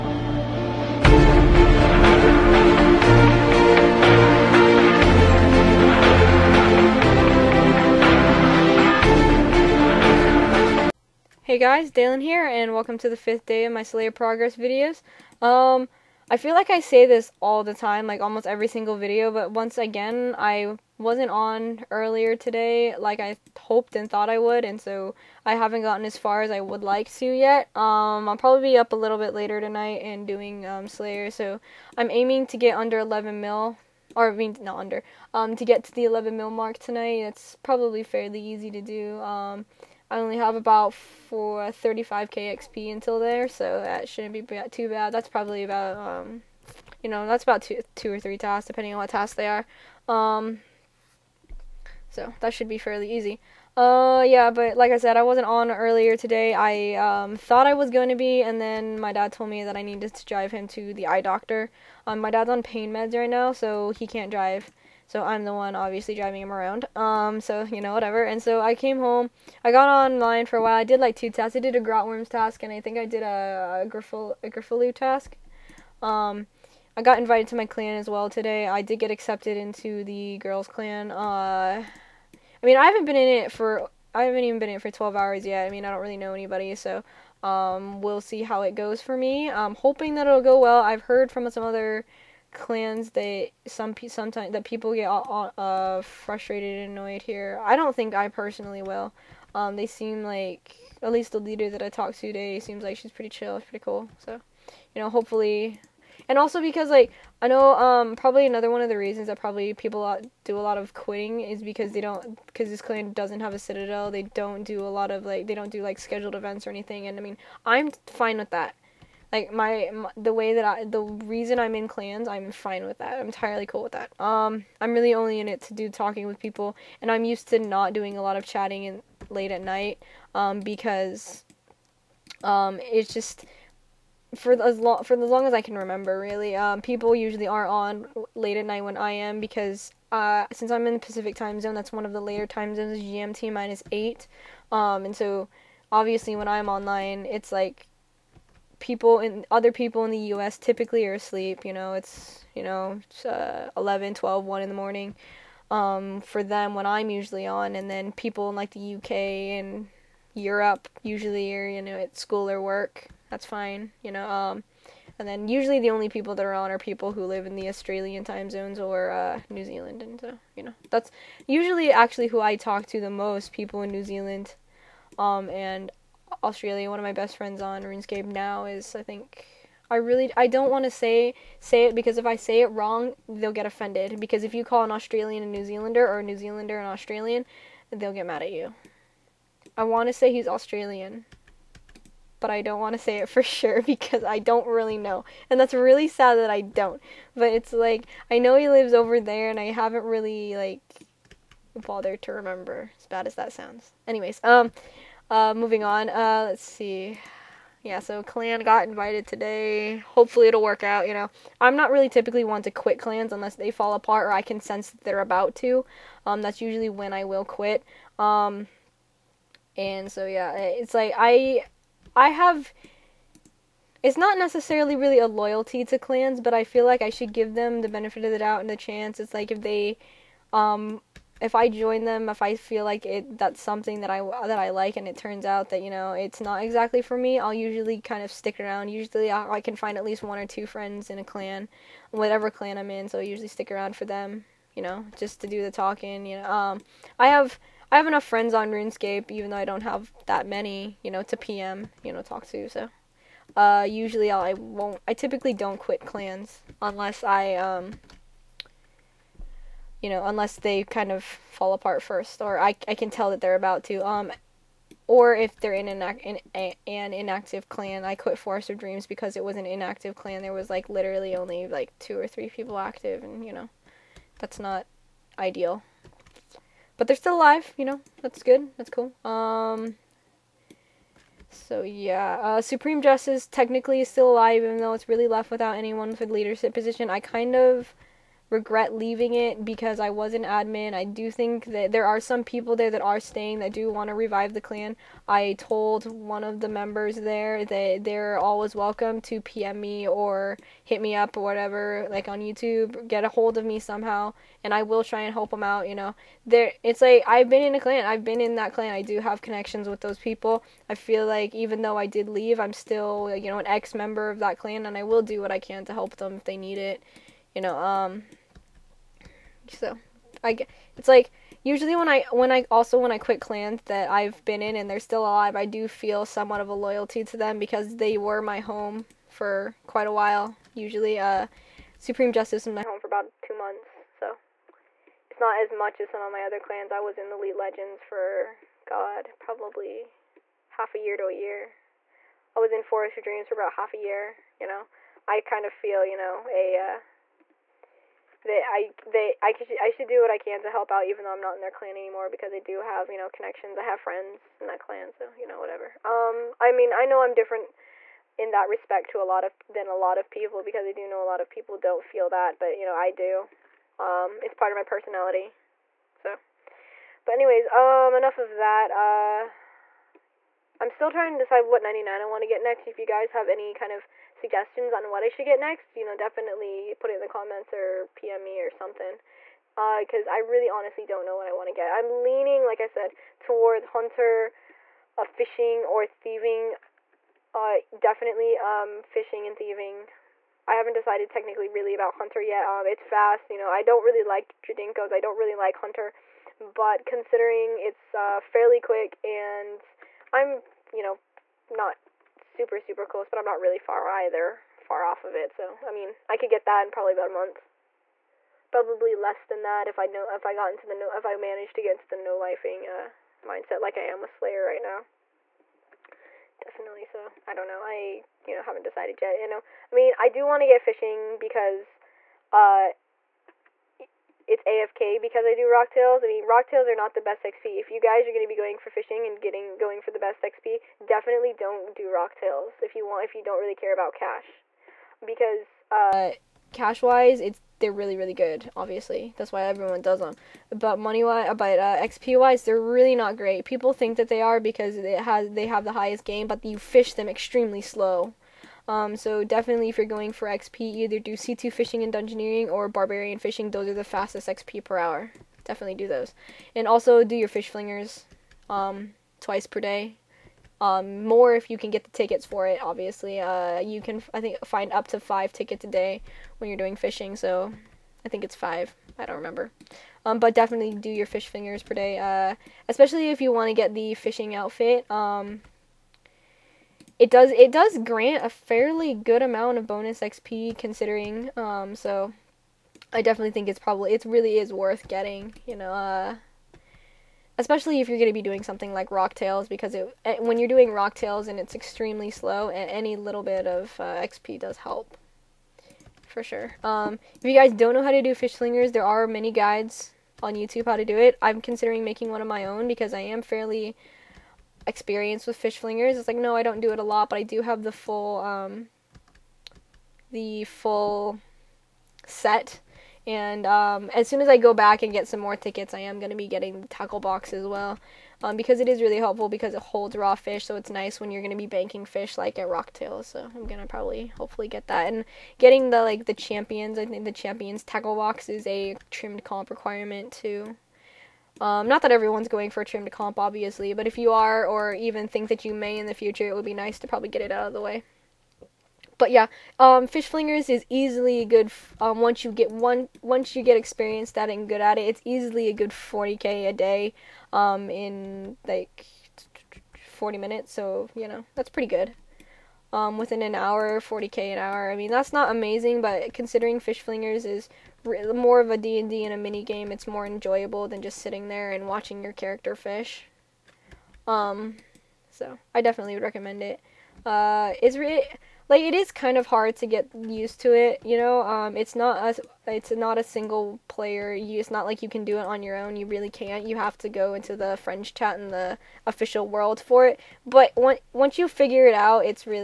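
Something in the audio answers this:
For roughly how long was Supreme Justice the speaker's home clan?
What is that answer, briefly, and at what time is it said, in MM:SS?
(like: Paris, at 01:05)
2 months, at 05:33.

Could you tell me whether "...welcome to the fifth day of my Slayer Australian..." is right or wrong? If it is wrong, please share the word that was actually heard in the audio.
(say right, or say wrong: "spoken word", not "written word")
wrong: "Progress", not "Australian".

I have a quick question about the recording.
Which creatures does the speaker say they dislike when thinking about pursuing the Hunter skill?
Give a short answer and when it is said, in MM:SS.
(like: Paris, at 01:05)
Jadinkos, at 06:34.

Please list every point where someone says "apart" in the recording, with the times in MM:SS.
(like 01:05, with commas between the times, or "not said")
03:33, 04:21.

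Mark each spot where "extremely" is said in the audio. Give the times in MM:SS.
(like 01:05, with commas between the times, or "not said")
07:27, 08:11.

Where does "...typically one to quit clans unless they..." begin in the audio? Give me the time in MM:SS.
03:32.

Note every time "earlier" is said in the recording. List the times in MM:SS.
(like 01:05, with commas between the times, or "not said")
00:21, 00:55.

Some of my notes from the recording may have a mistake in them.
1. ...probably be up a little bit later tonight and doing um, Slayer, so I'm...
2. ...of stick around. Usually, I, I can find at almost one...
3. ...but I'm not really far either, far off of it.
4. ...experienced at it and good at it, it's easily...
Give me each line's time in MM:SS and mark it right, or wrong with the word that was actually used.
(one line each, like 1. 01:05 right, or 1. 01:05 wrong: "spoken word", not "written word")
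1. 00:28 right
2. 03:58 wrong: "least", not "almost"
3. 06:43 right
4. 09:03 right.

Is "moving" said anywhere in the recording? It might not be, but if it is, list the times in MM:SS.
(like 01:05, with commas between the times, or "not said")
03:25.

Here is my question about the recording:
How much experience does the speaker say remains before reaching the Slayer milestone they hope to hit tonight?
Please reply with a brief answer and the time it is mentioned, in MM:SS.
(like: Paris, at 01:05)
35k, at 00:41.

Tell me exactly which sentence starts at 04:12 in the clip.
So, uh, usually I'll, I won't.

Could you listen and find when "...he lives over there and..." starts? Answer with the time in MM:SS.
03:18.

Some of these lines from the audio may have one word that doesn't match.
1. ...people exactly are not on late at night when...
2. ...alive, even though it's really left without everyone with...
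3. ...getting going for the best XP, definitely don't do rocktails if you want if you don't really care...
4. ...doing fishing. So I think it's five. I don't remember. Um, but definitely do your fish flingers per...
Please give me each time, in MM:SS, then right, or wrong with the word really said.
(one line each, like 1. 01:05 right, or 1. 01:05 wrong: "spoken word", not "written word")
1. 02:16 wrong: "usually", not "exactly"
2. 04:44 wrong: "anyone", not "everyone"
3. 07:09 right
4. 07:46 right.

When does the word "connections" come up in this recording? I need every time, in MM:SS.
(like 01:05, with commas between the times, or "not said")
05:09, 05:53.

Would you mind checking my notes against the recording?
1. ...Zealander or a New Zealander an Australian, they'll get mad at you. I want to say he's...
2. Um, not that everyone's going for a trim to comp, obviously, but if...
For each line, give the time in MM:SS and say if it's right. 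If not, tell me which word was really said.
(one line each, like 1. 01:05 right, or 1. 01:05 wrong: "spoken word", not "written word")
1. 03:05 right
2. 08:51 right.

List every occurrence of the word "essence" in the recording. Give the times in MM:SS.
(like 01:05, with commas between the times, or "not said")
not said.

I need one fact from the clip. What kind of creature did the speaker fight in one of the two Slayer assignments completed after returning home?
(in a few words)
Grotworms.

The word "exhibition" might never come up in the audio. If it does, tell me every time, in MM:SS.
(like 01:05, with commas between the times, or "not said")
not said.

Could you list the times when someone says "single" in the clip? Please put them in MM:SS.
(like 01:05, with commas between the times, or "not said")
00:18, 09:33.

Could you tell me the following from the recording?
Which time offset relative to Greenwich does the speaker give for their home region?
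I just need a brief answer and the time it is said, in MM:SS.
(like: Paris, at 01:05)
GMT minus eight, at 02:22.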